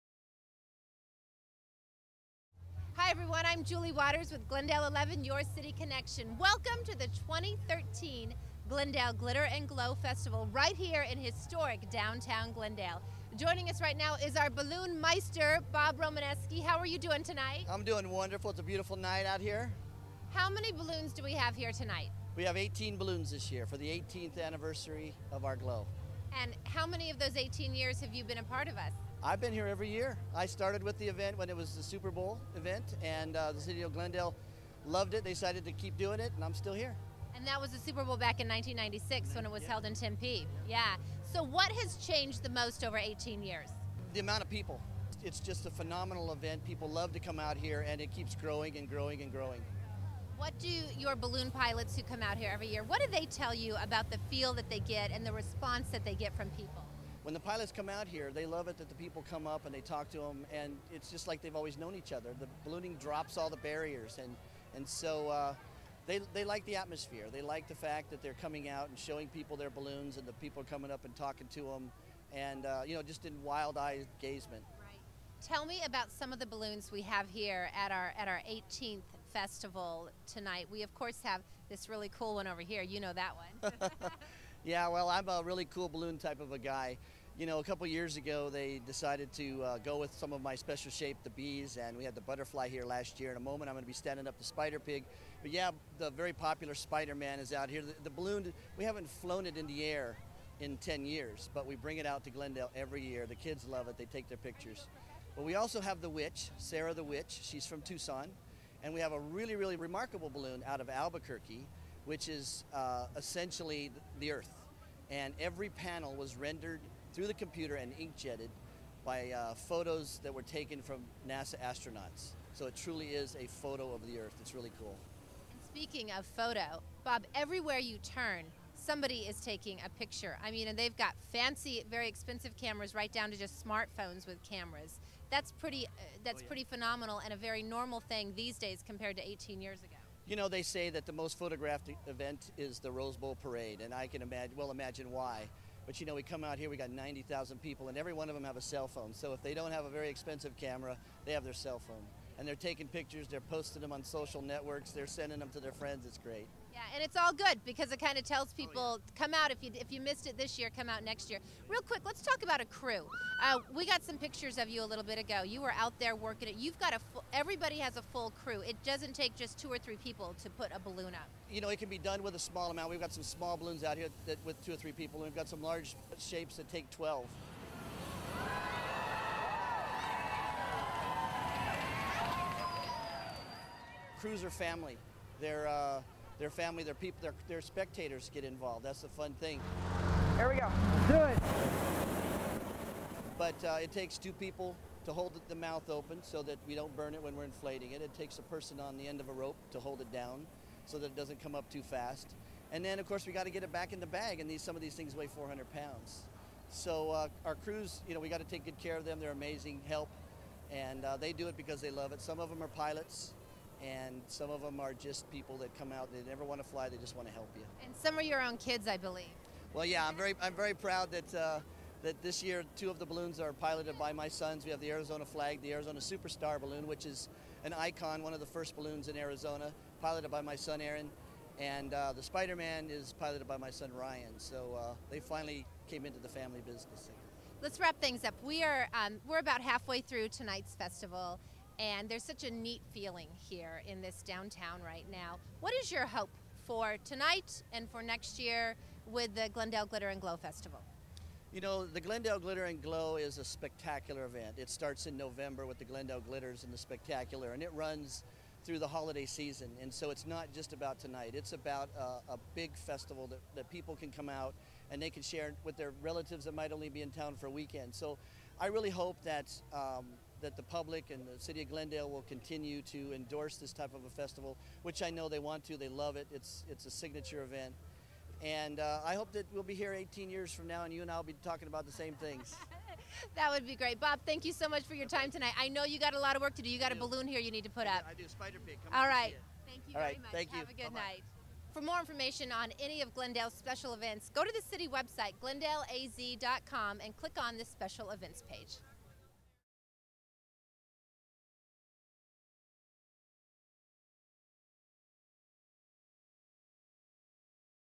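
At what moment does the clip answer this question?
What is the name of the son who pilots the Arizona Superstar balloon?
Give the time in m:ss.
3:50.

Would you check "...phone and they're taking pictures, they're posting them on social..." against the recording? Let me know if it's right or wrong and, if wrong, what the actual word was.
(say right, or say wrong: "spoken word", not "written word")
right.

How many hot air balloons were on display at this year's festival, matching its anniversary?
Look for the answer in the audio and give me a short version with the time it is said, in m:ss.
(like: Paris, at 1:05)
18, at 0:22.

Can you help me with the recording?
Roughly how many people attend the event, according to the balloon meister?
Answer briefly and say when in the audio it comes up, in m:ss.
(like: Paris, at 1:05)
90,000, at 2:26.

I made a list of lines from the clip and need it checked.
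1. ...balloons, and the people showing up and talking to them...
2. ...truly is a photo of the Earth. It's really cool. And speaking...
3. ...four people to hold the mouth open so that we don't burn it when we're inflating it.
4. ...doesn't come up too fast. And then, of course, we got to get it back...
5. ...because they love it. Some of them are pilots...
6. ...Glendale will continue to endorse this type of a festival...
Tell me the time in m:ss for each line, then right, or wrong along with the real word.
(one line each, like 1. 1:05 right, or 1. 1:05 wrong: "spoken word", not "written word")
1. 1:09 wrong: "coming", not "showing"
2. 2:02 right
3. 3:14 wrong: "two", not "four"
4. 3:21 right
5. 3:31 right
6. 4:31 right.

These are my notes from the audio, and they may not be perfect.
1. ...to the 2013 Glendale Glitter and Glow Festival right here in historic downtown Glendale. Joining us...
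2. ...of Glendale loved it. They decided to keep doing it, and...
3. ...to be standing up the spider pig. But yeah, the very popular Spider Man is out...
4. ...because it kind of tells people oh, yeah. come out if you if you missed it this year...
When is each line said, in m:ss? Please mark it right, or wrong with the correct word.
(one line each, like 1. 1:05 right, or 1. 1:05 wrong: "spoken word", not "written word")
1. 0:06 right
2. 0:33 right
3. 1:33 right
4. 2:37 right.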